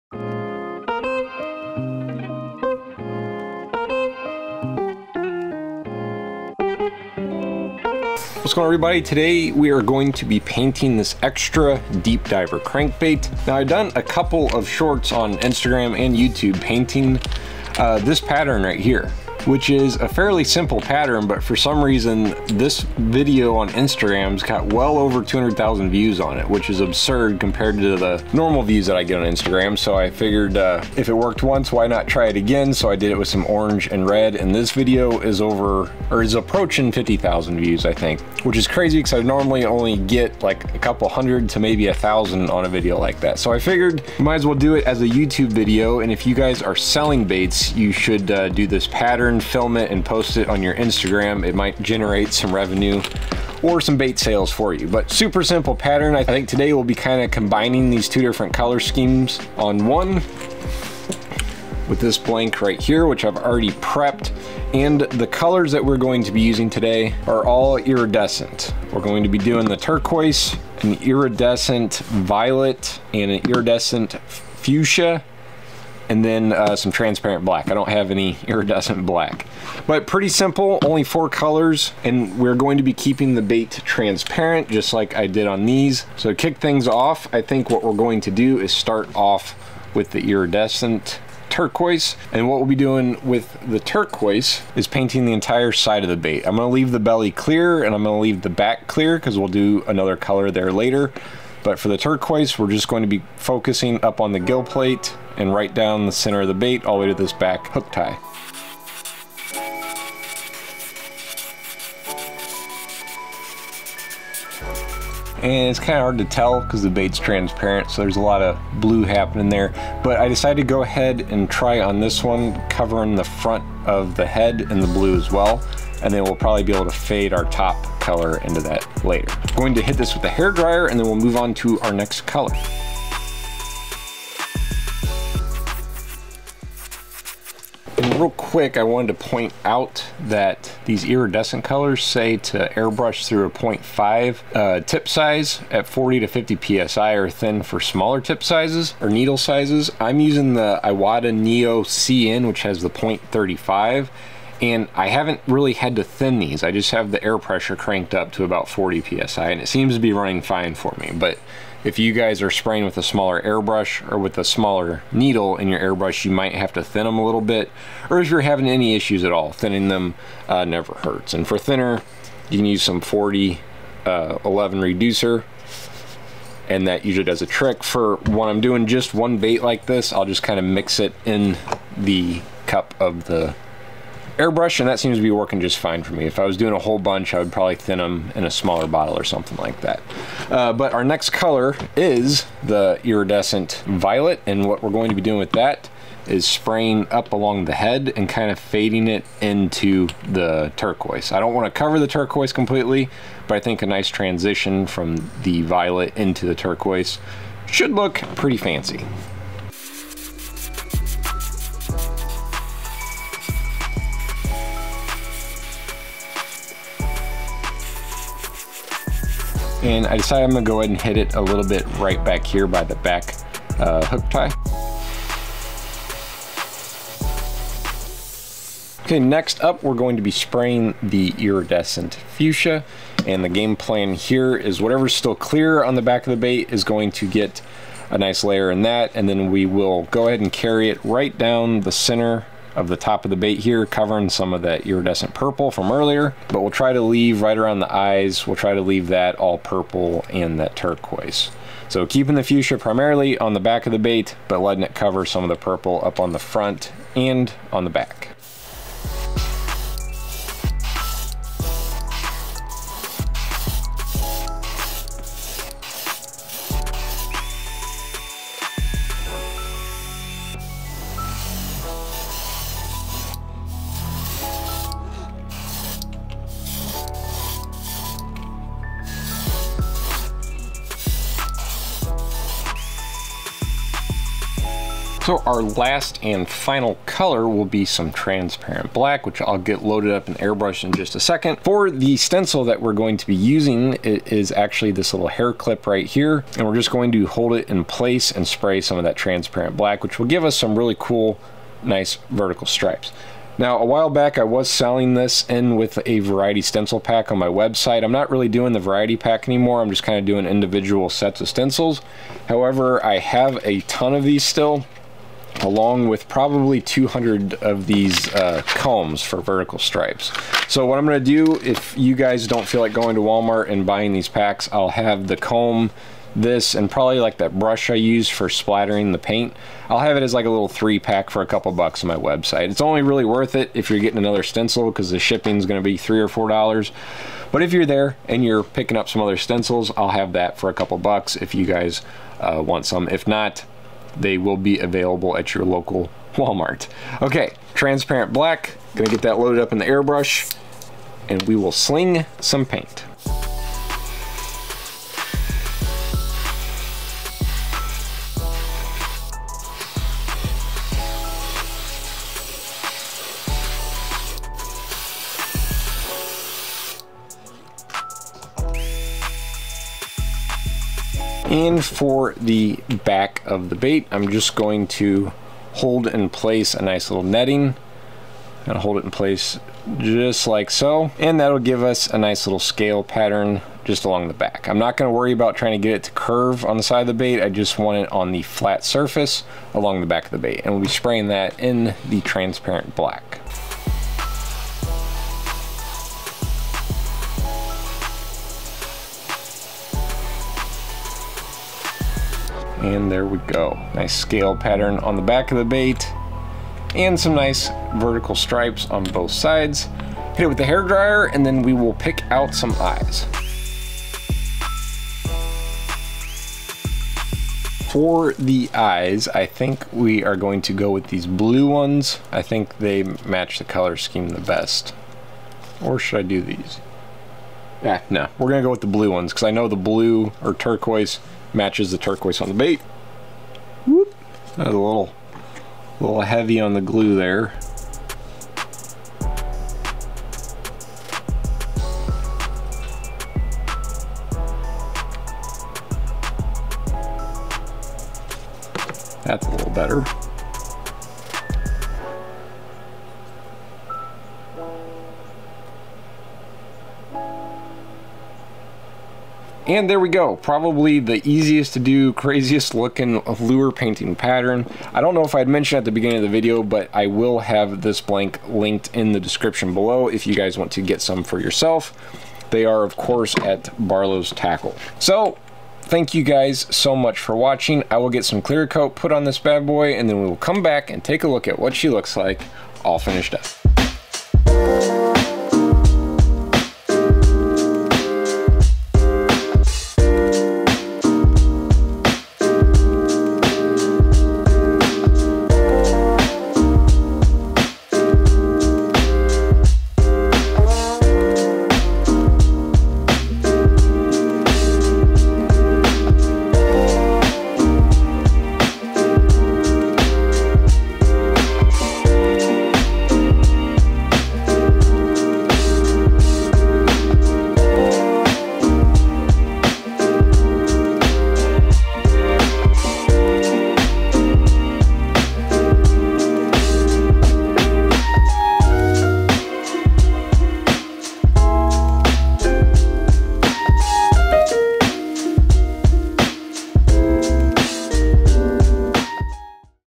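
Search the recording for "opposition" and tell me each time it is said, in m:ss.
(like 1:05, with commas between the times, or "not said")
not said.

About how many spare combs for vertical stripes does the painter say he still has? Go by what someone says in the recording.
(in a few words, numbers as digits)
200.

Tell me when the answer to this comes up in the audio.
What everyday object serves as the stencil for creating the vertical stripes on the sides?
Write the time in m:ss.
4:55.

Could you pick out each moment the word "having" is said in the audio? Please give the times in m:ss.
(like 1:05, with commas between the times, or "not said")
2:48.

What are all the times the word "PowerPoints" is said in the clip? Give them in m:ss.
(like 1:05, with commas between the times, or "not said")
not said.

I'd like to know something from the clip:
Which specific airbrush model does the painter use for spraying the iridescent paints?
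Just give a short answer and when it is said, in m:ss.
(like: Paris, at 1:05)
Iwata Neo CN, at 2:30.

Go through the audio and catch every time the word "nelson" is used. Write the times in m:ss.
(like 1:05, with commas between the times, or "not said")
not said.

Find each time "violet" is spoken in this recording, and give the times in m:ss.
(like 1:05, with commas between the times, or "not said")
1:11, 3:13, 3:25.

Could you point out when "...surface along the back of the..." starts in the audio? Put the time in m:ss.
6:28.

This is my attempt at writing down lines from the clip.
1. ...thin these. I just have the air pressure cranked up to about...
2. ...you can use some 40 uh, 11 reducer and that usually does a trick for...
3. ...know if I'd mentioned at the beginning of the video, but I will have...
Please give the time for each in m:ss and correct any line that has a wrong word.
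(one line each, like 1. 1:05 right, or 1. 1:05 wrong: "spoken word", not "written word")
1. 2:36 right
2. 2:52 right
3. 7:45 right.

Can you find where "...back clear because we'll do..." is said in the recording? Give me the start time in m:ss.
1:38.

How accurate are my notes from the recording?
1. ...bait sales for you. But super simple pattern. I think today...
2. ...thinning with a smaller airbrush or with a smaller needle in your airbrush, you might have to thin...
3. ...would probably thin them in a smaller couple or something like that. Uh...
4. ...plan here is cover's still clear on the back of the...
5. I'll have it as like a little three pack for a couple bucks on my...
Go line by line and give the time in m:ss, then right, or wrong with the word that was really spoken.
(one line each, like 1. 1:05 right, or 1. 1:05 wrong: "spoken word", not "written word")
1. 0:53 right
2. 2:42 wrong: "spraying", not "thinning"
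3. 3:07 wrong: "bottle", not "couple"
4. 3:53 wrong: "whatever", not "cover"
5. 5:29 right.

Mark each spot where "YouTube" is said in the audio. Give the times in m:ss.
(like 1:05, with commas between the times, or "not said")
0:16, 0:45.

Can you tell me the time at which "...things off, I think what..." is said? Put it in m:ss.
1:26.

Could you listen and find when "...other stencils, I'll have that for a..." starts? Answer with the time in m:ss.
5:39.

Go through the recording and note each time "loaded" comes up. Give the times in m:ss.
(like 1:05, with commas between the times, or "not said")
4:49, 5:49.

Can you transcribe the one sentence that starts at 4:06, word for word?
But we'll try to leave right around the eyes, we'll try to leave that all purple and that turquoise.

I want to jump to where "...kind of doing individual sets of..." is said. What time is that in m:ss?
5:10.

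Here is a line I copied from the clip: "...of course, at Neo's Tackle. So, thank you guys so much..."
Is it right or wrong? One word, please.
wrong.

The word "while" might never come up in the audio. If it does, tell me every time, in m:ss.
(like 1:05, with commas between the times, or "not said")
5:03.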